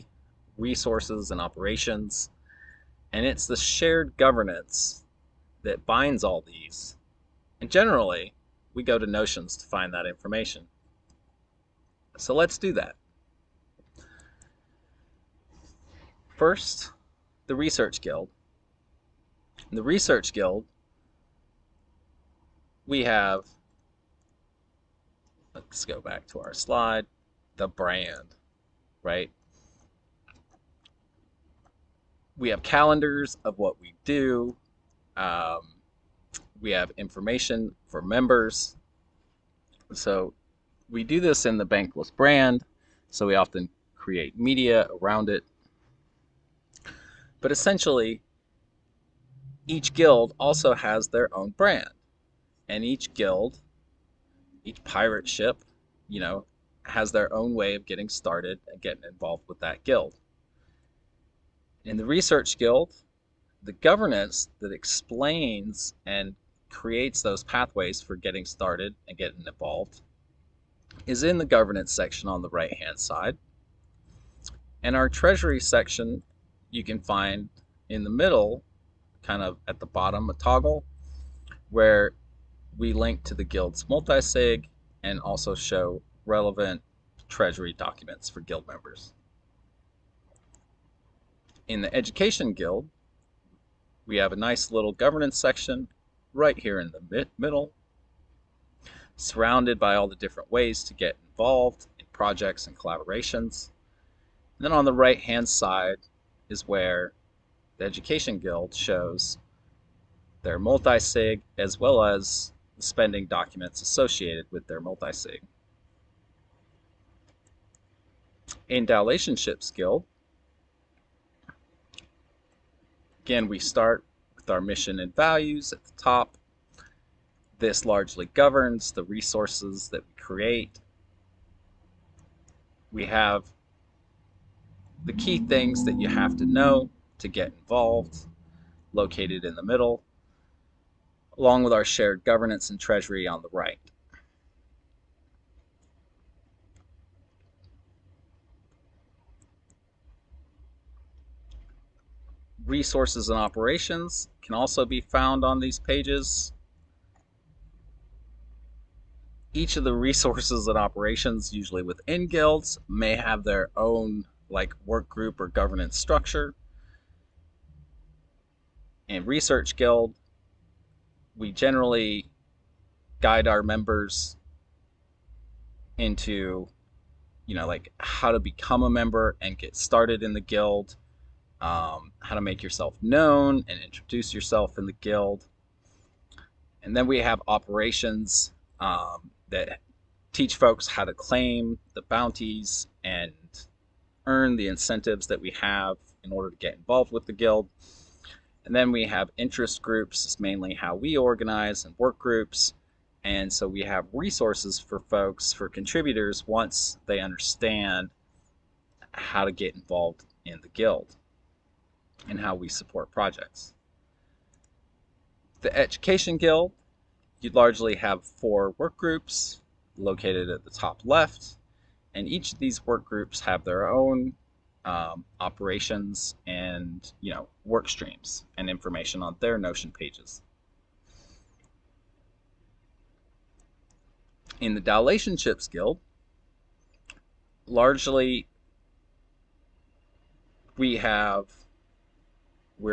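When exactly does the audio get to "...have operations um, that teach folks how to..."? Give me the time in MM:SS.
03:07.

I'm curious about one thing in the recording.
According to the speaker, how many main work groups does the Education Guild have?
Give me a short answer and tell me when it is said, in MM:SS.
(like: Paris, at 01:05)
4, at 03:38.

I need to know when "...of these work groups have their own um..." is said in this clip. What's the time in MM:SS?
03:42.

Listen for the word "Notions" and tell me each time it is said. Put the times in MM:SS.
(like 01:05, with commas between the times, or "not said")
00:09, 03:49.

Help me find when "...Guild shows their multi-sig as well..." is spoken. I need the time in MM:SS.
01:48.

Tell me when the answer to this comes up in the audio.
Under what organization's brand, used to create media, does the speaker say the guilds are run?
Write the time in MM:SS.
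00:41.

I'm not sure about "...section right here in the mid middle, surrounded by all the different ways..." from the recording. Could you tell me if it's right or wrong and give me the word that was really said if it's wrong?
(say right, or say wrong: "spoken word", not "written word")
right.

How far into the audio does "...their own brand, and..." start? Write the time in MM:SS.
00:51.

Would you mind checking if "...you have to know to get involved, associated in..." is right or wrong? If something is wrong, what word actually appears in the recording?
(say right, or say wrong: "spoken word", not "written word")
wrong: "located", not "associated".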